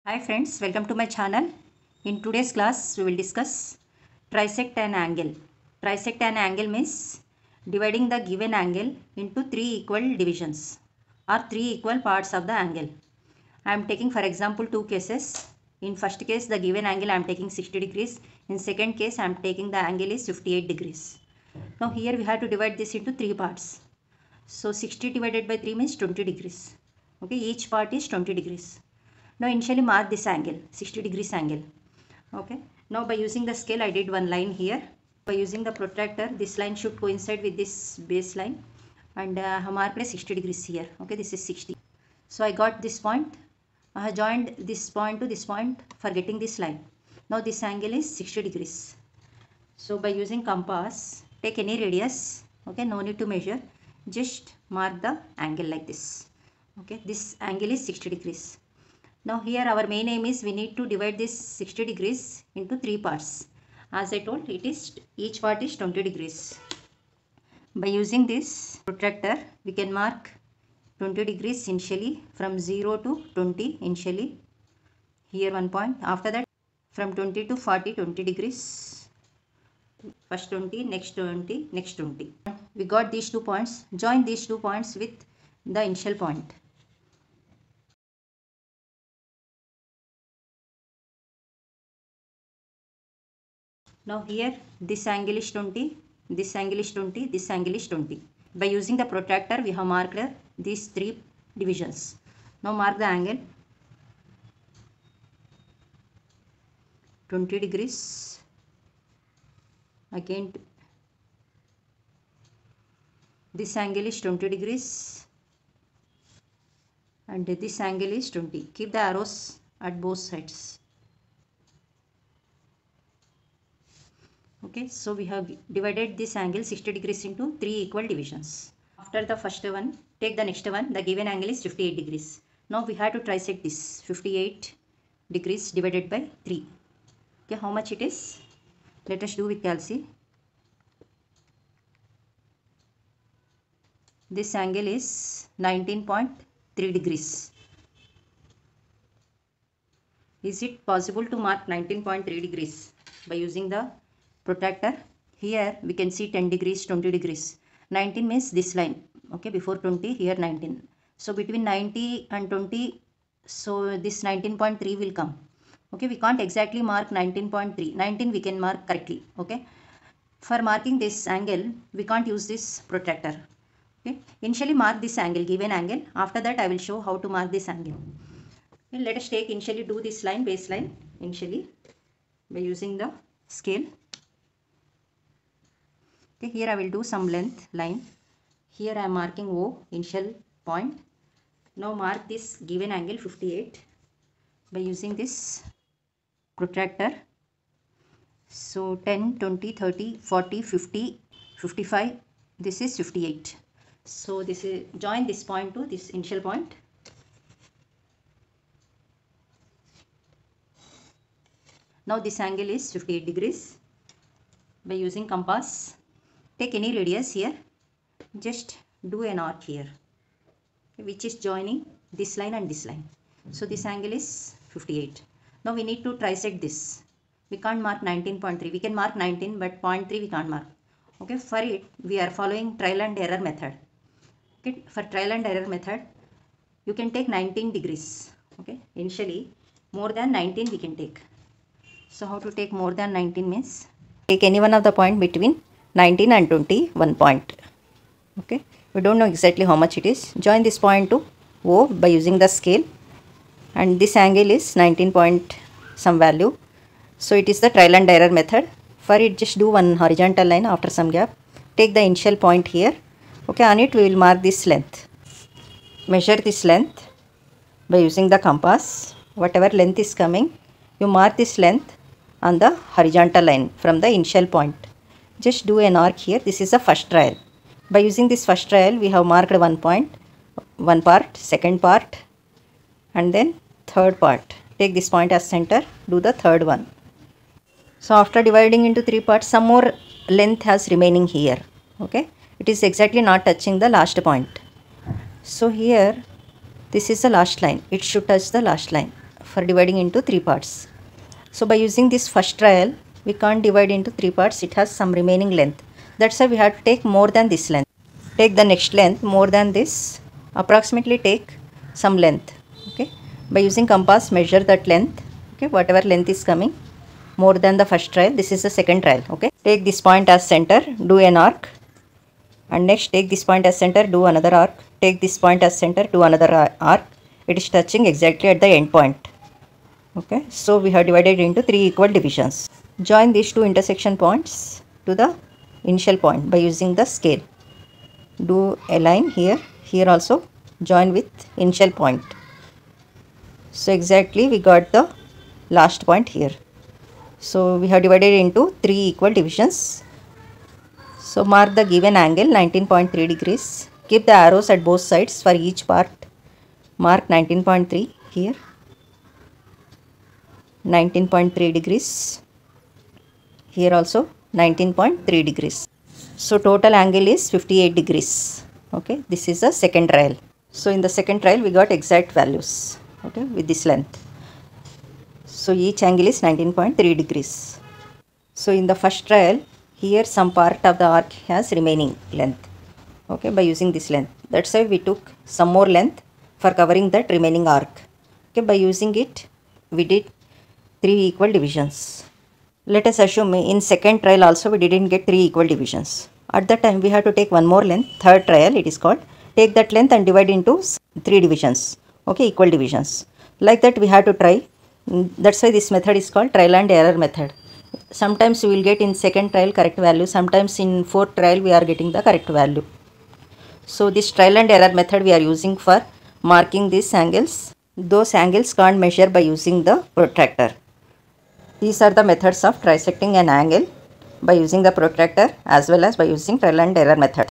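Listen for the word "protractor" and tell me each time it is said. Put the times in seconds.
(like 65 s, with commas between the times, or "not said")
35 s, 68 s, 99 s, 154 s, 172 s, 196 s, 420 s, 424 s.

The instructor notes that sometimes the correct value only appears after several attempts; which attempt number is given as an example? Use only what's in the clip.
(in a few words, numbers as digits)
fourth trial.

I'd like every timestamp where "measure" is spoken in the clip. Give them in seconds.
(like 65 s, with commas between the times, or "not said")
53 s, 266 s, 314 s, 418 s.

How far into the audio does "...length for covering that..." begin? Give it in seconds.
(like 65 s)
385 s.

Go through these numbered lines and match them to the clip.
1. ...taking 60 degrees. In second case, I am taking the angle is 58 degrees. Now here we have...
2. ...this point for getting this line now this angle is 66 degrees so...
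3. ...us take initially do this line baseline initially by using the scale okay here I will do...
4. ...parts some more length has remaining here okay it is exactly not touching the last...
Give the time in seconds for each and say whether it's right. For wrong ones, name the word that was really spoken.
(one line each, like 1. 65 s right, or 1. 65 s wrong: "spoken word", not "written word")
1. 17 s right
2. 45 s wrong: "60", not "66"
3. 179 s right
4. 289 s right.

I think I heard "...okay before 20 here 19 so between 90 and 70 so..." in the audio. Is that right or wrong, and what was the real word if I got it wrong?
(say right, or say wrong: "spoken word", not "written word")
wrong: "20", not "70".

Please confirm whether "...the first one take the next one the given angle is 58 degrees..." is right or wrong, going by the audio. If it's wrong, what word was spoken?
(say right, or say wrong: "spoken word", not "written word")
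right.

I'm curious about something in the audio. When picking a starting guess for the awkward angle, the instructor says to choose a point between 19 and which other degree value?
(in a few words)
21.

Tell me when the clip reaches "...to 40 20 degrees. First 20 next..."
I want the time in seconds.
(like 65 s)
77 s.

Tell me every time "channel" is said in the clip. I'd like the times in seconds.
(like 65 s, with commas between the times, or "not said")
1 s.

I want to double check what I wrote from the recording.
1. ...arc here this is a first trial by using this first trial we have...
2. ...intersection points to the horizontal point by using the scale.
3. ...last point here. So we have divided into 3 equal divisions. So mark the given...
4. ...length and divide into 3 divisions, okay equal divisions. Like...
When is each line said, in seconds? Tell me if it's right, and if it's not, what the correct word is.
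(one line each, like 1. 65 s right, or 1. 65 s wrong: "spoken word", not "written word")
1. 276 s right
2. 333 s wrong: "initial", not "horizontal"
3. 345 s right
4. 399 s right.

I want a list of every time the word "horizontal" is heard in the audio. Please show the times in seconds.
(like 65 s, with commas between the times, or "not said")
260 s, 272 s.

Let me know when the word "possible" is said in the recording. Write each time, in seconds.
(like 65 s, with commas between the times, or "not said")
150 s.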